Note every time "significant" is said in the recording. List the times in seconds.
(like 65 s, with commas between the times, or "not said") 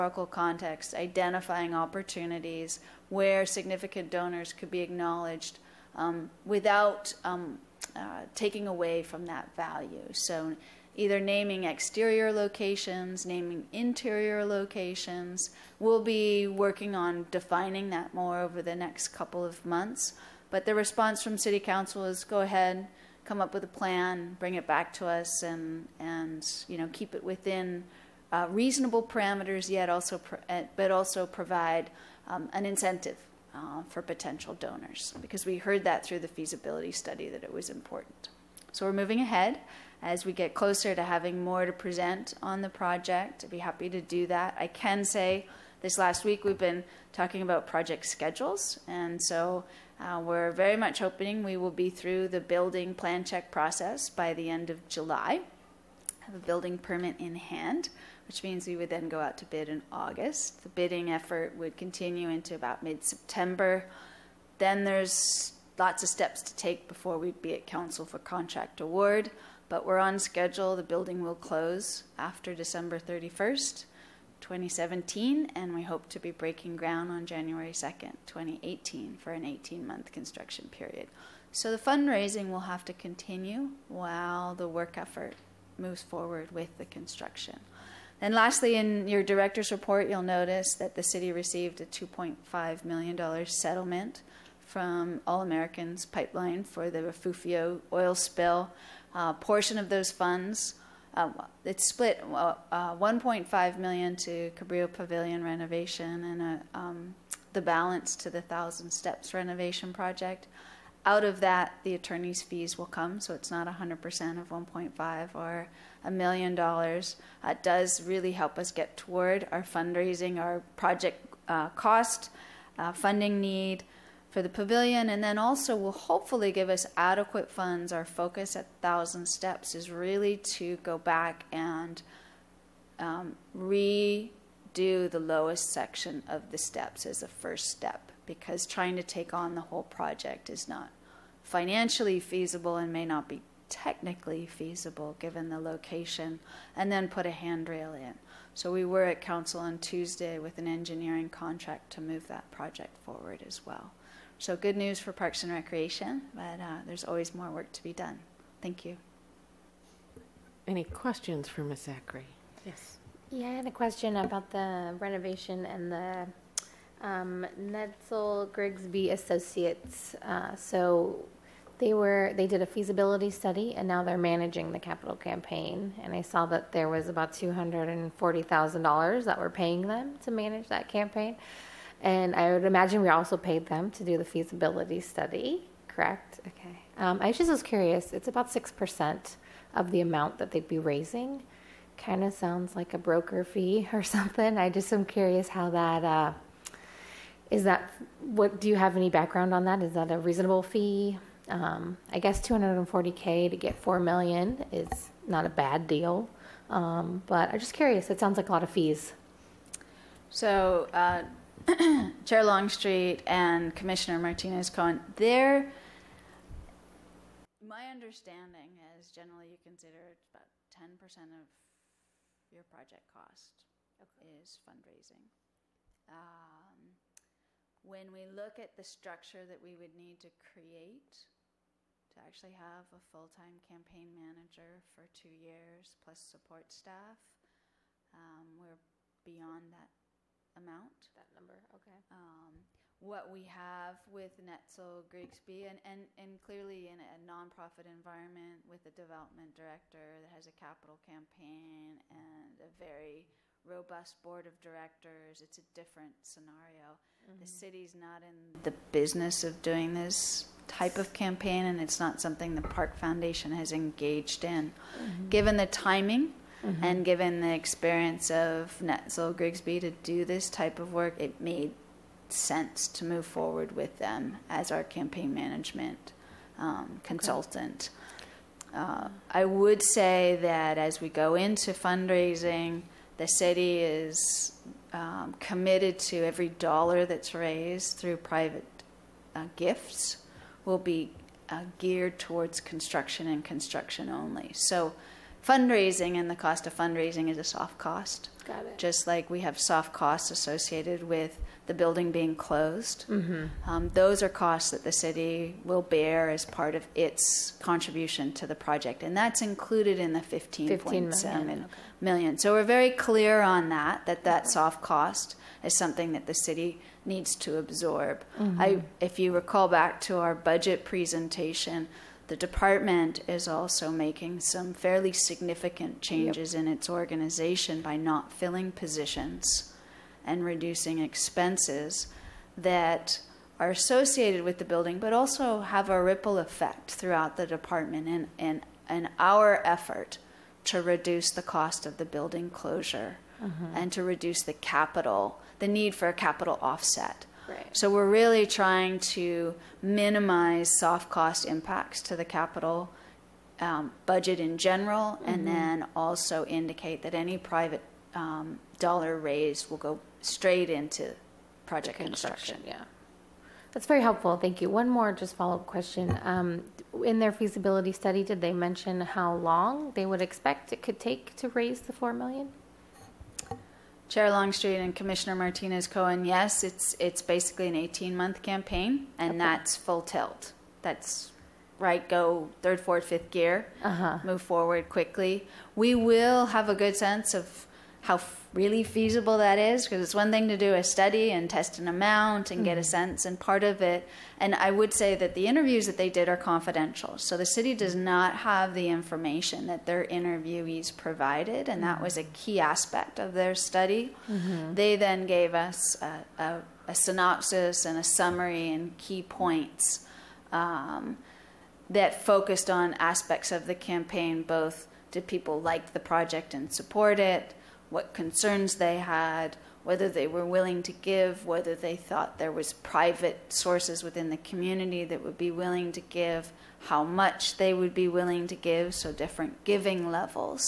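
3 s, 325 s.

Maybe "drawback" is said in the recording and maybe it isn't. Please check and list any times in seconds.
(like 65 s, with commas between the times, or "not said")
not said.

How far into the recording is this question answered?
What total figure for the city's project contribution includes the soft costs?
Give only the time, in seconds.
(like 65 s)
310 s.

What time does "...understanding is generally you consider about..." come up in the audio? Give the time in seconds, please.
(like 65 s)
217 s.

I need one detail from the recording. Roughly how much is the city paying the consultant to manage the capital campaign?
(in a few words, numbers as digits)
$240,000.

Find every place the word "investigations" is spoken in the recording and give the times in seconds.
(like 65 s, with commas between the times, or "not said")
not said.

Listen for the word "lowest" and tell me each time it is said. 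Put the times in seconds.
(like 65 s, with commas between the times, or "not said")
135 s.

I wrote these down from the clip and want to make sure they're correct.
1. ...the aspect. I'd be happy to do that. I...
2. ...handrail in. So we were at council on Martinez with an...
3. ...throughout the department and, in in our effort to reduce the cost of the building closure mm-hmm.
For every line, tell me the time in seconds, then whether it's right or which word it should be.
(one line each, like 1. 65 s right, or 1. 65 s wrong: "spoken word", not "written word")
1. 42 s wrong: "project", not "aspect"
2. 147 s wrong: "Tuesday", not "Martinez"
3. 336 s right.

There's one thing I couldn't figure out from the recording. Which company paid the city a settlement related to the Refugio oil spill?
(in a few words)
All Americans Pipeline.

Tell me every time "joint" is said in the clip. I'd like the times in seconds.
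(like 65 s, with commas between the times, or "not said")
not said.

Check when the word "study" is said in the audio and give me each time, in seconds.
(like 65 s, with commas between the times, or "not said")
36 s, 173 s, 184 s, 367 s, 390 s, 403 s.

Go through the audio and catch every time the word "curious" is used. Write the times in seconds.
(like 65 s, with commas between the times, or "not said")
187 s, 195 s, 207 s.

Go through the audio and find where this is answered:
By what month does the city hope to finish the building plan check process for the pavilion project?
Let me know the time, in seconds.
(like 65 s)
54 s.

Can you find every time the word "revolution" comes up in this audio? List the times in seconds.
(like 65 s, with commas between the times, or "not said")
not said.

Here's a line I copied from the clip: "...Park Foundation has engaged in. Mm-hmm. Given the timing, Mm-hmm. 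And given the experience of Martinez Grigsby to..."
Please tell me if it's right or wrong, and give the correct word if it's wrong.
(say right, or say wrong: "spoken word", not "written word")
wrong: "Netzel", not "Martinez".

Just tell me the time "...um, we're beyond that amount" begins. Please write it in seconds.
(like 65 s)
238 s.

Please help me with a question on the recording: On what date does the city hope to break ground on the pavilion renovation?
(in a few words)
January 2, 2018.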